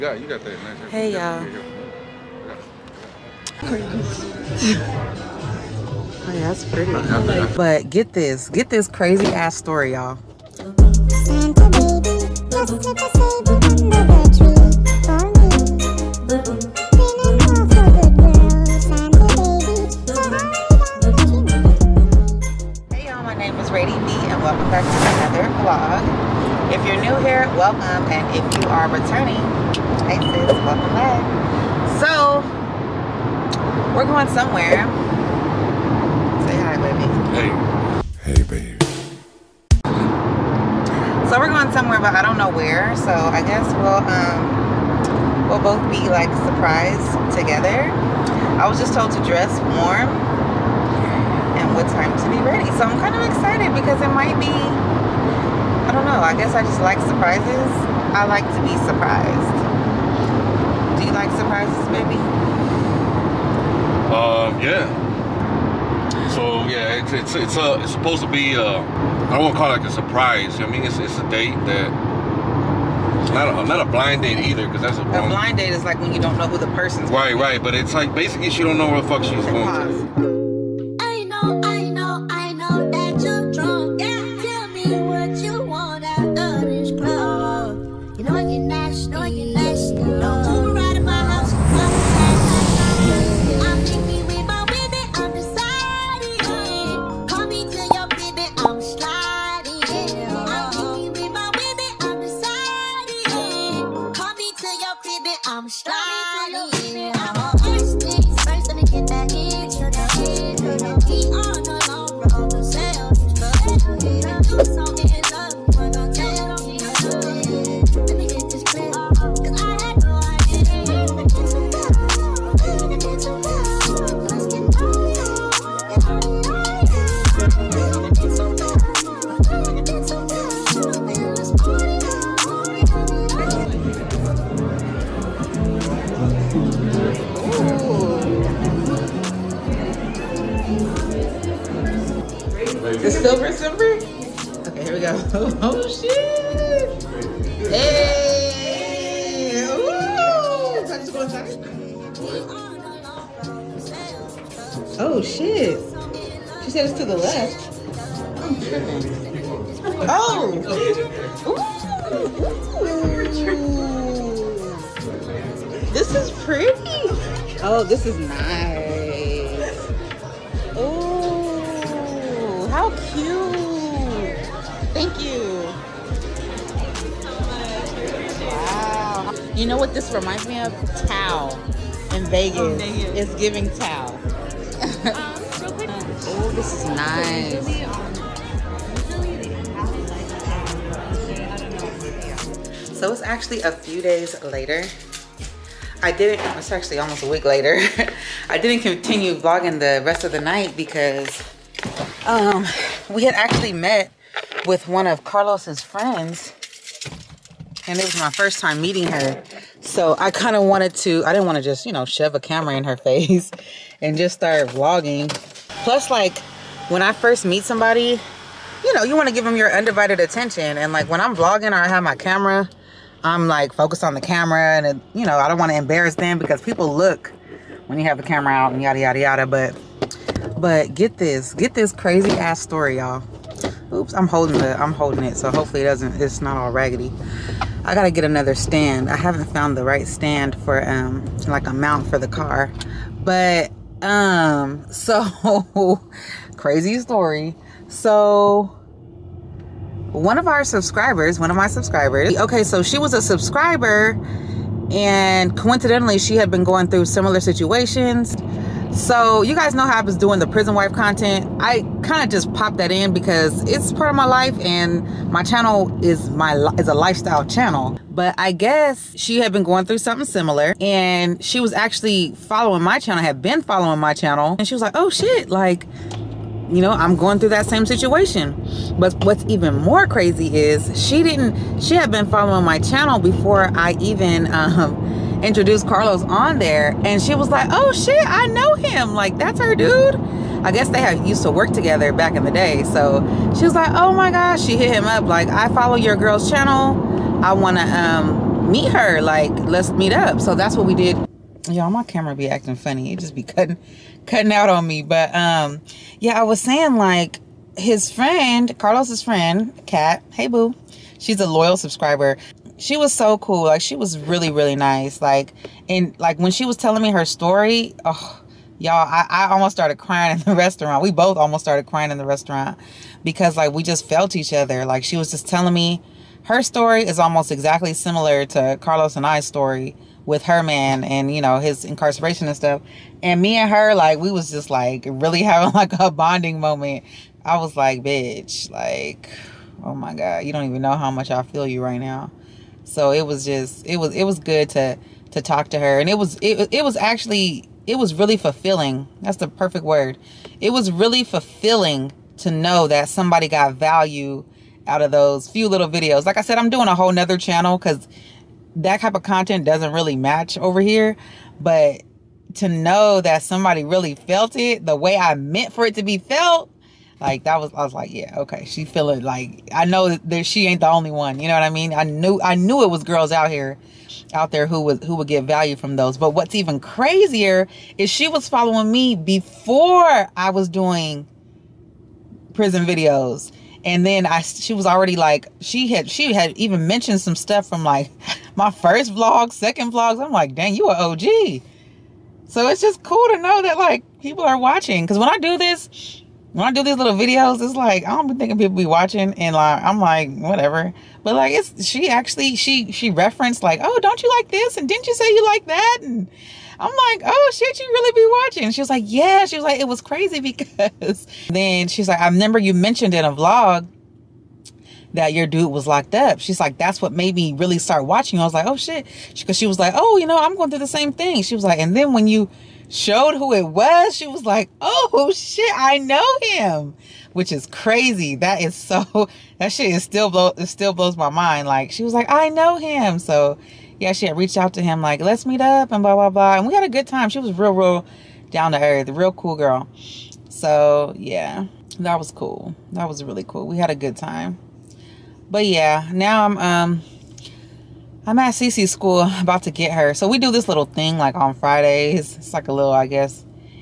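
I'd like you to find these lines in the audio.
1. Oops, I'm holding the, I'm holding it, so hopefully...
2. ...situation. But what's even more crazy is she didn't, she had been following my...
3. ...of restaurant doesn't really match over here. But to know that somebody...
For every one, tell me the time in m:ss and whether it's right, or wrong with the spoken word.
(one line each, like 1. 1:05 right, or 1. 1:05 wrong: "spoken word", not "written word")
1. 3:53 right
2. 4:37 right
3. 5:59 wrong: "content", not "restaurant".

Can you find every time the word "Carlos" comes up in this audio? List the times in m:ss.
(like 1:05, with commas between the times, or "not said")
3:25, 4:45, 5:08, 5:28.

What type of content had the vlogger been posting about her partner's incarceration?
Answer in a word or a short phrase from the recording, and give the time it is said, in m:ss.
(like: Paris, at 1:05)
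prison wife content, at 4:20.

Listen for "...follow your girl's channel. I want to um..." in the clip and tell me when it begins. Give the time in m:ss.
4:55.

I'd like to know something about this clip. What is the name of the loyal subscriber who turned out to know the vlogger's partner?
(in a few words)
Kat.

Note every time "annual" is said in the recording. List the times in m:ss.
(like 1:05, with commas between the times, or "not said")
not said.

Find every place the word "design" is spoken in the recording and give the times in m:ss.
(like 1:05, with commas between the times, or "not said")
not said.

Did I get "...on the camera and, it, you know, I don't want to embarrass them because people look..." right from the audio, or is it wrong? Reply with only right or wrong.
right.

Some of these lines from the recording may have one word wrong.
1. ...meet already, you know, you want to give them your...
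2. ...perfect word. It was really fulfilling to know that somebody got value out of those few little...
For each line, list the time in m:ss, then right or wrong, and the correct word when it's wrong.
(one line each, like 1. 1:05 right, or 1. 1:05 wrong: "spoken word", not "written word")
1. 3:37 wrong: "somebody", not "already"
2. 5:49 right.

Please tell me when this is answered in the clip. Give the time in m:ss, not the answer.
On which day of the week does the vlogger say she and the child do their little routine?
7:31.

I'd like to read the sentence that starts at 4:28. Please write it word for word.
But I guess she had been going through something similar and she was actually following my channel, had been following my channel.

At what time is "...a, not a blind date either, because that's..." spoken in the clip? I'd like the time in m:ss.
1:13.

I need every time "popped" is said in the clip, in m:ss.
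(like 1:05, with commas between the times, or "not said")
4:22.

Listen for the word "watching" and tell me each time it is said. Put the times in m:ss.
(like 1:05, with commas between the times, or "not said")
6:34, 6:38, 6:48, 6:58.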